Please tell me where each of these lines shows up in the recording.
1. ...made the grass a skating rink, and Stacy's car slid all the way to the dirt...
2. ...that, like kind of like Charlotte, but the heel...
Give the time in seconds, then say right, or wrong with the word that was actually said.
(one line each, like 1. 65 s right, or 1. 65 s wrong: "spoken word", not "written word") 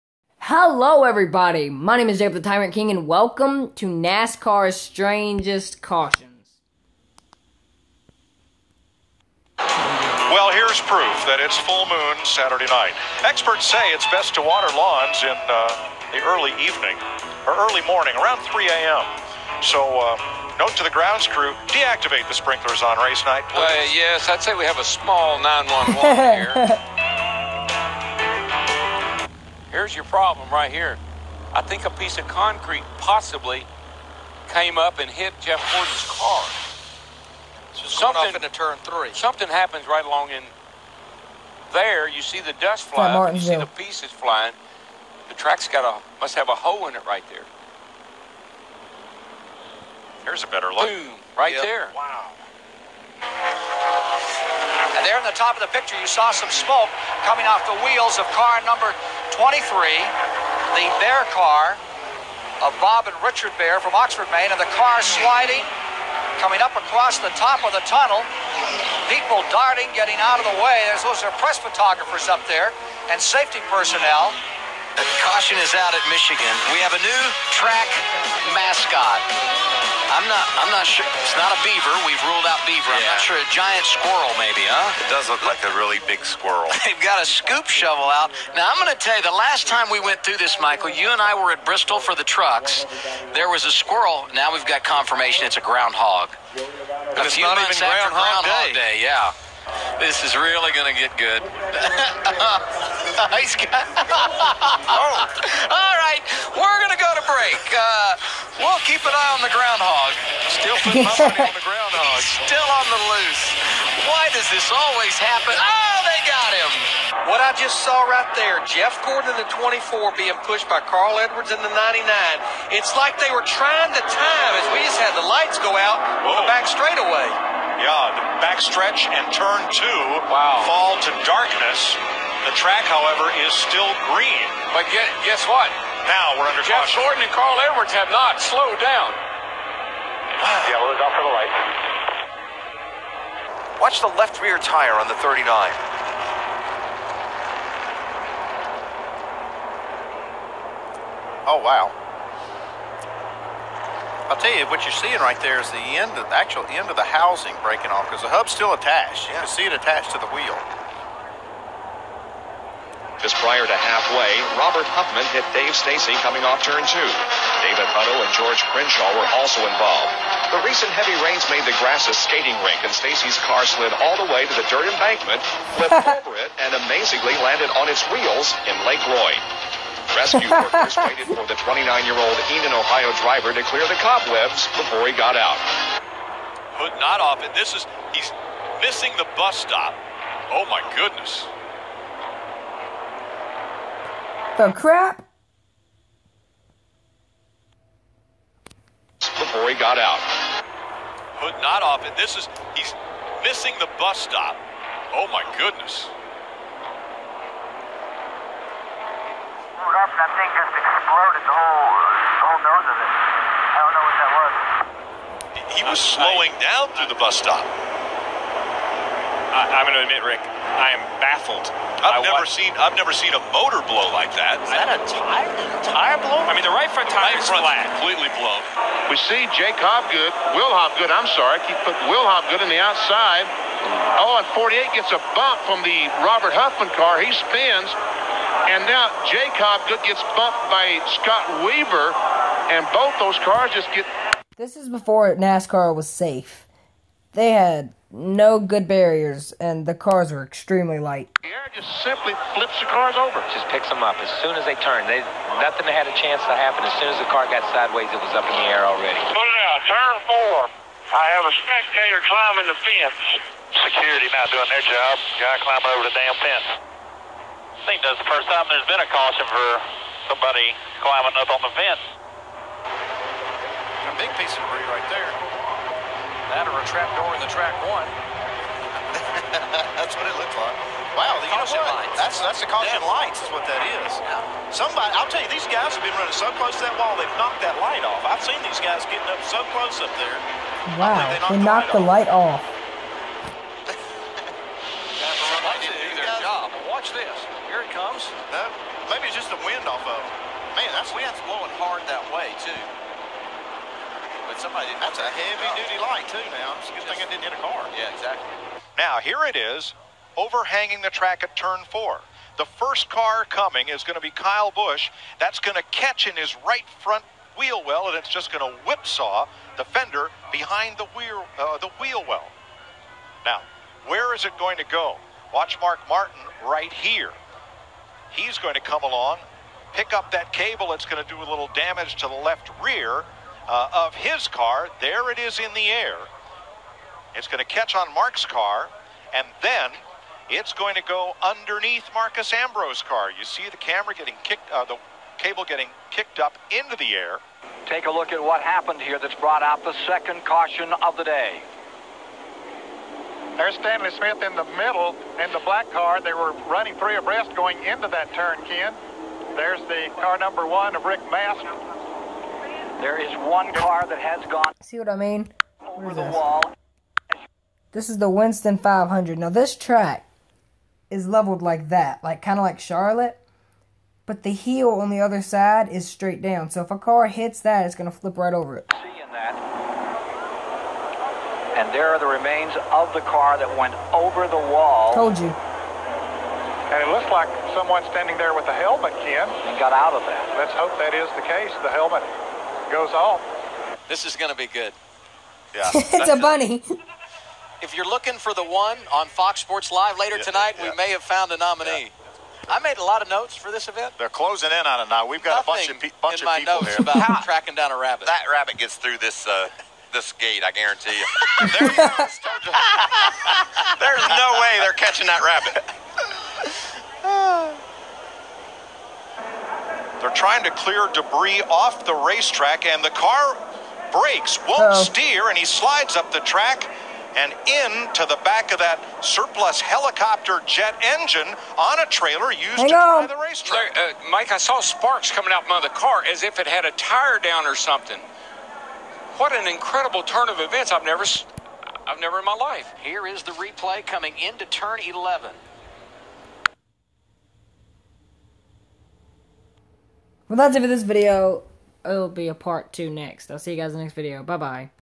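1. 171 s right
2. 371 s right.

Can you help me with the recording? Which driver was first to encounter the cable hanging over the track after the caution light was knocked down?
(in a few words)
Kyle Busch.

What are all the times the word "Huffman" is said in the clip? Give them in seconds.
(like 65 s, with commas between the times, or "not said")
164 s, 236 s.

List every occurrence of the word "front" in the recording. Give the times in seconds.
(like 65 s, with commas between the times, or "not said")
226 s, 317 s.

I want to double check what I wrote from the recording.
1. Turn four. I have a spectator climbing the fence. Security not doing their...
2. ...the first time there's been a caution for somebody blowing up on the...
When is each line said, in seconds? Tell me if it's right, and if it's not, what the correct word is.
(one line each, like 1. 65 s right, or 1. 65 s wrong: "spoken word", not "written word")
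1. 259 s right
2. 268 s wrong: "climbing", not "blowing".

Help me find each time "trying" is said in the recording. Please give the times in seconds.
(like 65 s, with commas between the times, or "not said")
123 s, 420 s.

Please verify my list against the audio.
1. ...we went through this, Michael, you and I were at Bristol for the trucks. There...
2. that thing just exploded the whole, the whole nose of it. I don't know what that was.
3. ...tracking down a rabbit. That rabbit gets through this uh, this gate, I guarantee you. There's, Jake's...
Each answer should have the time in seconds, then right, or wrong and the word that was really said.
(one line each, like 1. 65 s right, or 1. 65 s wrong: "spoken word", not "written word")
1. 89 s right
2. 210 s right
3. 407 s wrong: "There", not "Jake".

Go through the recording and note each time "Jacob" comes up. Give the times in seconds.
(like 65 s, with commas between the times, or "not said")
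2 s, 239 s.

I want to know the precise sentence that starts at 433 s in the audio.
uh, Mike, I saw sparks coming out from the car as if it had a tire down or something.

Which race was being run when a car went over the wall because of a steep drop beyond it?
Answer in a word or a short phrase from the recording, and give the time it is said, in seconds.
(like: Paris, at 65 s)
Winston 500, at 368 s.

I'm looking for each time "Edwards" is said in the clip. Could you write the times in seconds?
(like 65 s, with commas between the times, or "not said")
121 s, 137 s.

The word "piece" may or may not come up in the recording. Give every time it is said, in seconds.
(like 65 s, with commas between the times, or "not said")
31 s, 43 s, 274 s.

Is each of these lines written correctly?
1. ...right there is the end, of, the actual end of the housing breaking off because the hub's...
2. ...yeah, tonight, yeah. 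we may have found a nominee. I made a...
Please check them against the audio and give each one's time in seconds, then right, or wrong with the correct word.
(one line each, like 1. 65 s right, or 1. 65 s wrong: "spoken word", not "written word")
1. 155 s right
2. 400 s right.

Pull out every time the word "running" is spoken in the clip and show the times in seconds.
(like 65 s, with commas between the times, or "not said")
286 s, 356 s.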